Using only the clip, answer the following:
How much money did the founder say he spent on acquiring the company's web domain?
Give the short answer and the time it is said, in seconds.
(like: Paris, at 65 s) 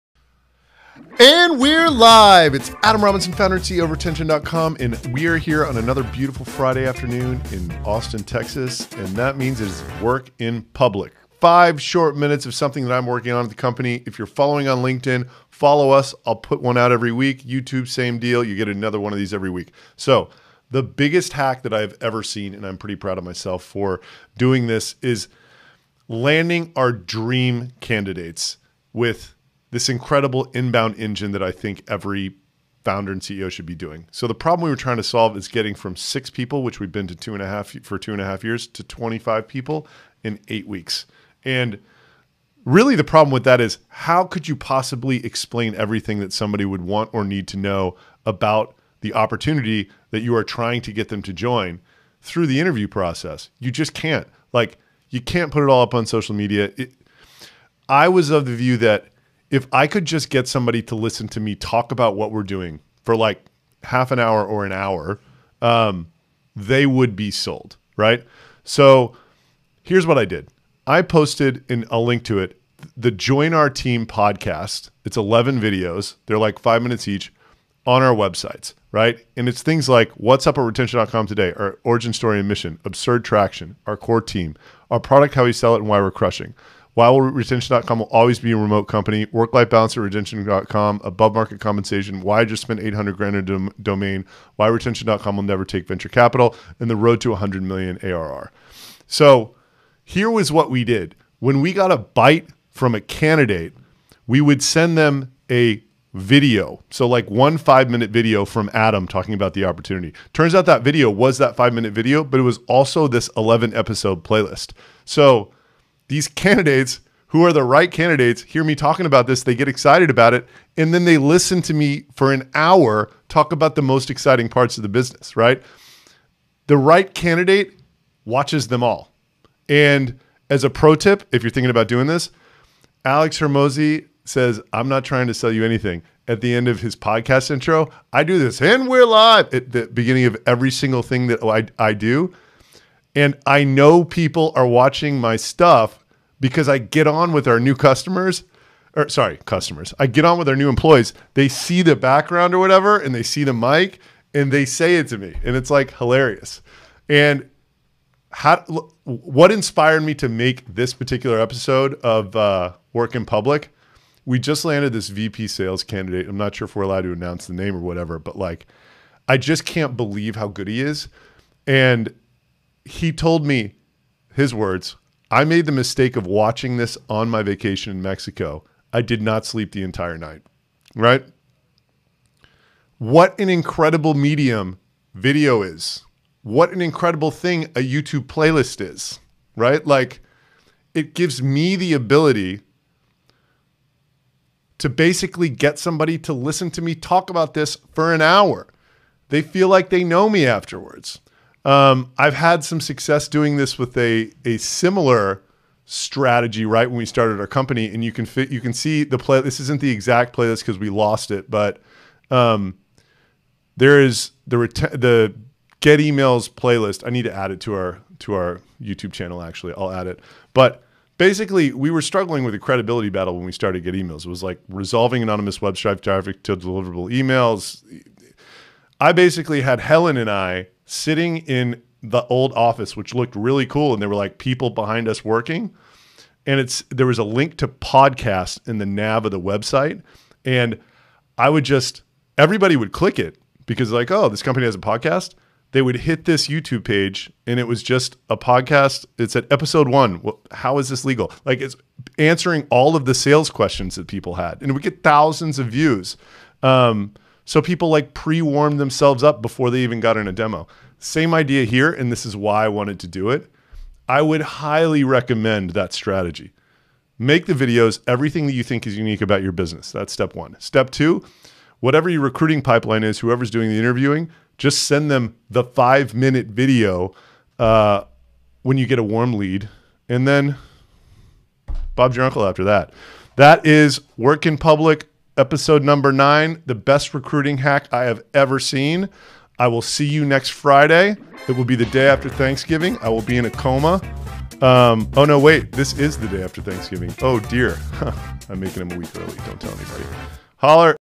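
$800,000, at 92 s.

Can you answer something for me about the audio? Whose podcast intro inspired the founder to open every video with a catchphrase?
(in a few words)
Alex Hormozi.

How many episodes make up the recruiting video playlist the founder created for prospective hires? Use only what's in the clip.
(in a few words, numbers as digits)
11.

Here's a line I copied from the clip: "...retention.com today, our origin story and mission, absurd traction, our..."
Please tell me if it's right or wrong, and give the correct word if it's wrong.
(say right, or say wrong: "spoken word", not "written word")
right.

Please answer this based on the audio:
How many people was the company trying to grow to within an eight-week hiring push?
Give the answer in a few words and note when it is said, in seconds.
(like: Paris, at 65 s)
25, at 38 s.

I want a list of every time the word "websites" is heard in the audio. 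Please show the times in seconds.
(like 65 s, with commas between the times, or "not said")
78 s, 239 s.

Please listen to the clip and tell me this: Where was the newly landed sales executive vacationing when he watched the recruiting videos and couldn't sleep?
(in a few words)
Mexico.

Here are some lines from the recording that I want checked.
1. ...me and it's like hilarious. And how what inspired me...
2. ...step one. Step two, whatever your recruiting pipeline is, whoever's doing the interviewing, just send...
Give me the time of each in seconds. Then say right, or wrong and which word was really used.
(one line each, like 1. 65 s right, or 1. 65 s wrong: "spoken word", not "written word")
1. 155 s right
2. 270 s right.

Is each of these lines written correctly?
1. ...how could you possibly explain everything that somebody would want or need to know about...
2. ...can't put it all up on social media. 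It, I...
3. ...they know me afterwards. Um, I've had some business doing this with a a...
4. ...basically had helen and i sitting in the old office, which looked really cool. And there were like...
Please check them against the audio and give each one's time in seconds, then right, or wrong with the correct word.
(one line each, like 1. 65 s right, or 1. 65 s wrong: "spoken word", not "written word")
1. 43 s right
2. 55 s right
3. 199 s wrong: "success", not "business"
4. 229 s right.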